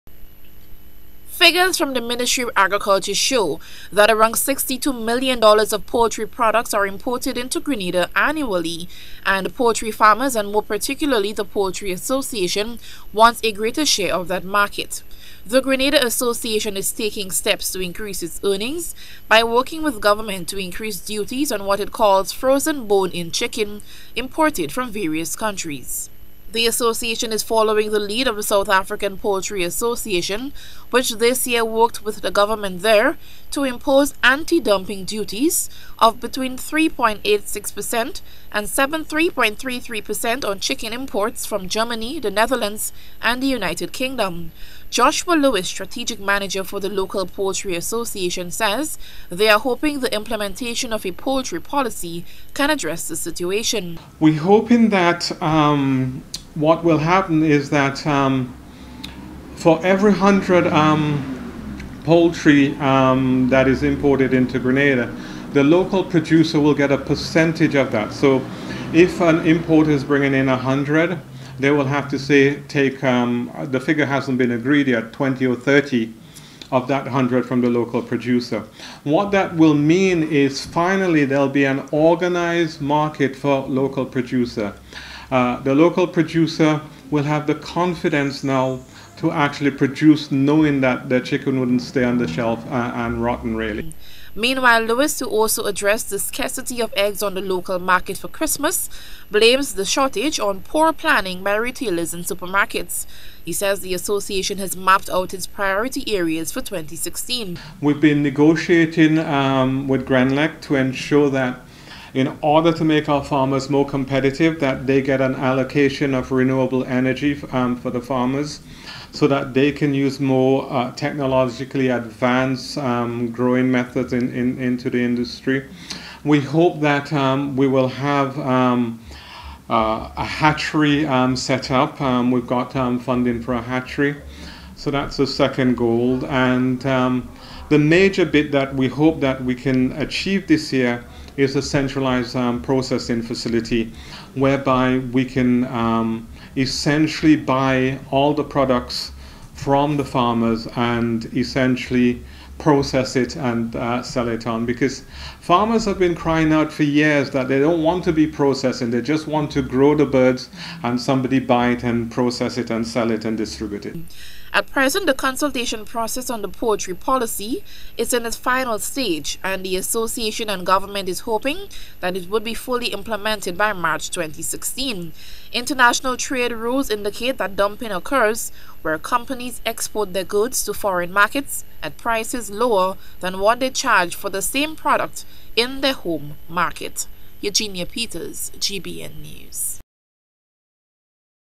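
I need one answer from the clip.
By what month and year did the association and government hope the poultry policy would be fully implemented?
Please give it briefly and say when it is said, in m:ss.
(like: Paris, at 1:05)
March 2016, at 2:53.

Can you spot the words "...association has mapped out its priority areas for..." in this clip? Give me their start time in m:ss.
1:43.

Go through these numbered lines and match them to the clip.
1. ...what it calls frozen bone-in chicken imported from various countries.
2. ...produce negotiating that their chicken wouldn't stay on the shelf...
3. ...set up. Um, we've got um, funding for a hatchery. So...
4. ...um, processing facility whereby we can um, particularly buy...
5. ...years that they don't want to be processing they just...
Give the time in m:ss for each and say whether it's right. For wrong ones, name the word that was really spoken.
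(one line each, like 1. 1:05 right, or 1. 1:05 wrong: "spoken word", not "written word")
1. 0:21 right
2. 1:29 wrong: "knowing", not "negotiating"
3. 2:11 right
4. 2:22 wrong: "essentially", not "particularly"
5. 2:36 right.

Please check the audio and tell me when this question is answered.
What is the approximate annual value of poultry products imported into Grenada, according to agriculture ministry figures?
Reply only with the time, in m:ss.
0:04.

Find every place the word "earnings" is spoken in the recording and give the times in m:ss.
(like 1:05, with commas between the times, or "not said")
0:18.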